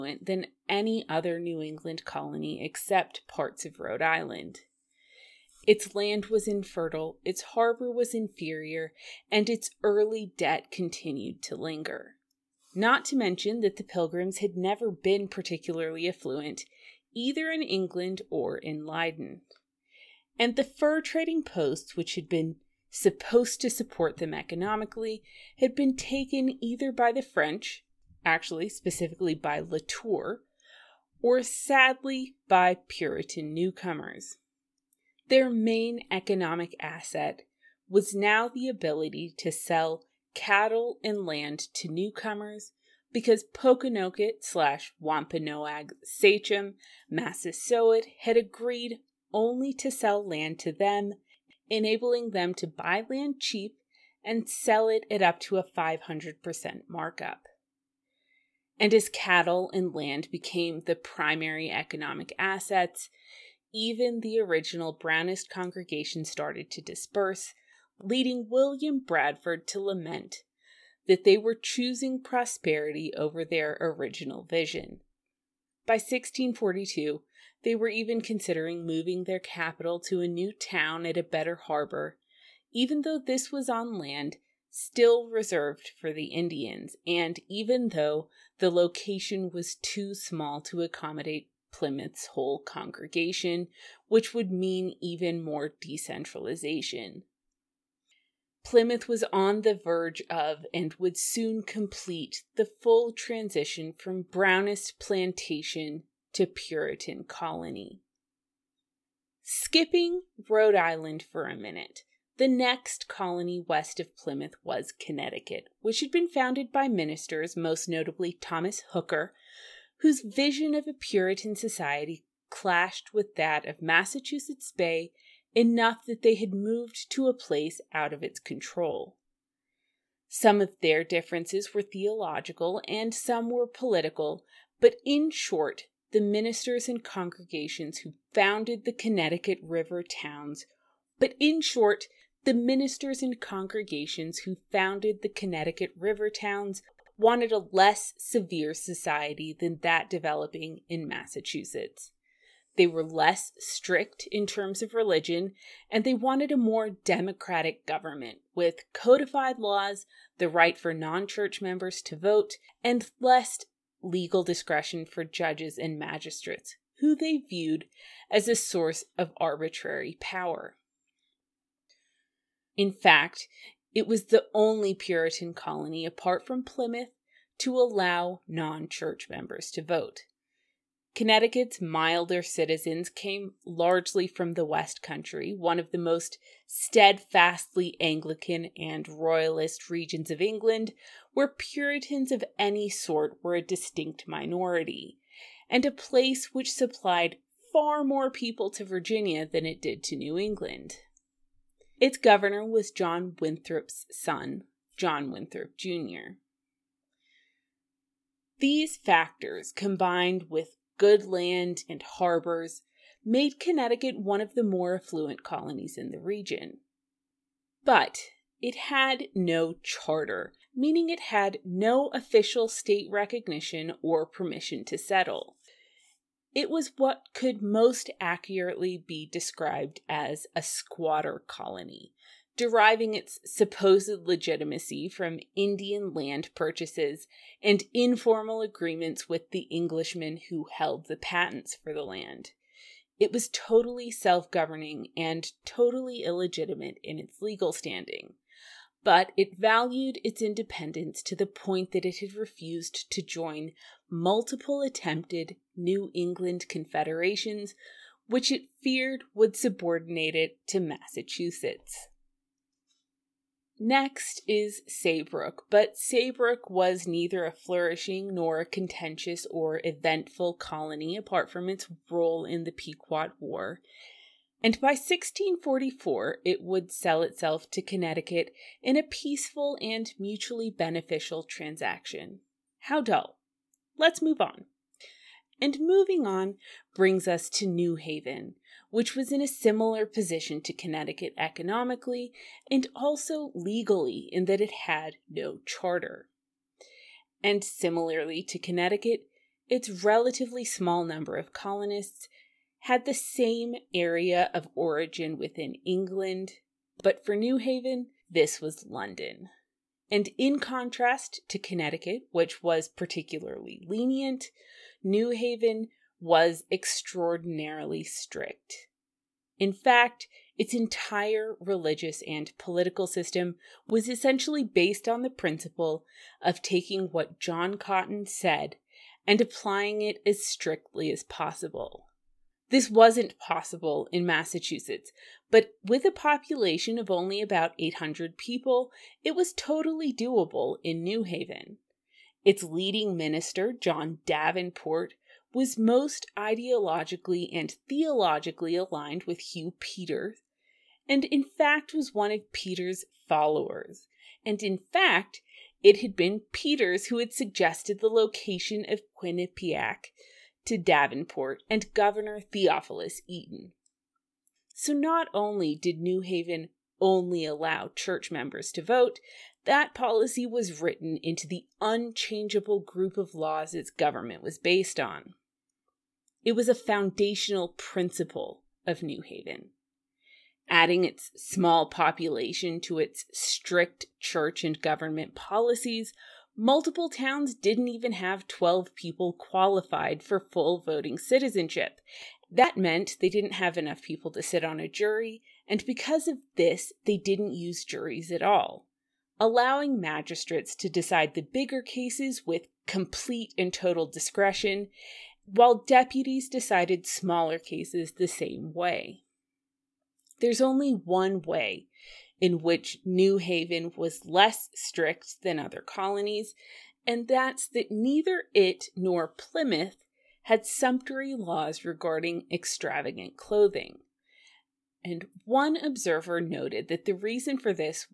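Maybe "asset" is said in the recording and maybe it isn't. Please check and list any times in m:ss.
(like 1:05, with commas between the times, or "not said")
0:36, 1:02.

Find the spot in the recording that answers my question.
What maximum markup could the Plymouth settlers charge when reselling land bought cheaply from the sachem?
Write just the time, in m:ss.
0:55.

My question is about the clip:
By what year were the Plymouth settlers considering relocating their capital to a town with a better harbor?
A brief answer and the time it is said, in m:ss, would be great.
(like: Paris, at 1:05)
1642, at 1:15.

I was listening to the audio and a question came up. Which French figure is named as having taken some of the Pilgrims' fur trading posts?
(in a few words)
Latour.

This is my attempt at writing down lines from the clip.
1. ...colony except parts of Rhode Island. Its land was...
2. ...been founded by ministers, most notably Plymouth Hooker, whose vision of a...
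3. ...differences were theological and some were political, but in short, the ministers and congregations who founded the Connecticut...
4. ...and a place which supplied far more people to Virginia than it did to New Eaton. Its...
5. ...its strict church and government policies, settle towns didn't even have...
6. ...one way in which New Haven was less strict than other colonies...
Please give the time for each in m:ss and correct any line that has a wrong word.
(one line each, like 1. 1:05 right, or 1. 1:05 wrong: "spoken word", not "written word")
1. 0:02 right
2. 1:56 wrong: "Thomas", not "Plymouth"
3. 2:11 right
4. 3:15 wrong: "England", not "Eaton"
5. 6:22 wrong: "multiple", not "settle"
6. 6:50 right.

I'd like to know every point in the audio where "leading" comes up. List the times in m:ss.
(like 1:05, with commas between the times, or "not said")
1:07, 5:42.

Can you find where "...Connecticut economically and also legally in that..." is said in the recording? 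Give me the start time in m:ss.
4:50.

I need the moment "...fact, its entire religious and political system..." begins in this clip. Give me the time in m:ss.
5:19.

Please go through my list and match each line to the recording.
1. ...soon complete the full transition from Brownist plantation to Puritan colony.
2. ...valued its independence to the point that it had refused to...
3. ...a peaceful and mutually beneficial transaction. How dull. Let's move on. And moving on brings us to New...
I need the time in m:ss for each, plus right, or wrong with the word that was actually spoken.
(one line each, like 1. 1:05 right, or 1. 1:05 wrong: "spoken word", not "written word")
1. 1:41 right
2. 4:09 right
3. 4:38 right.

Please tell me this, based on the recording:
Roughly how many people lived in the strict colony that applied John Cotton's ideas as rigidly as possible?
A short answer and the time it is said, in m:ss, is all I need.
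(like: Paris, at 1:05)
800, at 5:37.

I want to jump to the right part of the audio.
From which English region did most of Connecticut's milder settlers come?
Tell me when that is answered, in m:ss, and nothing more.
3:04.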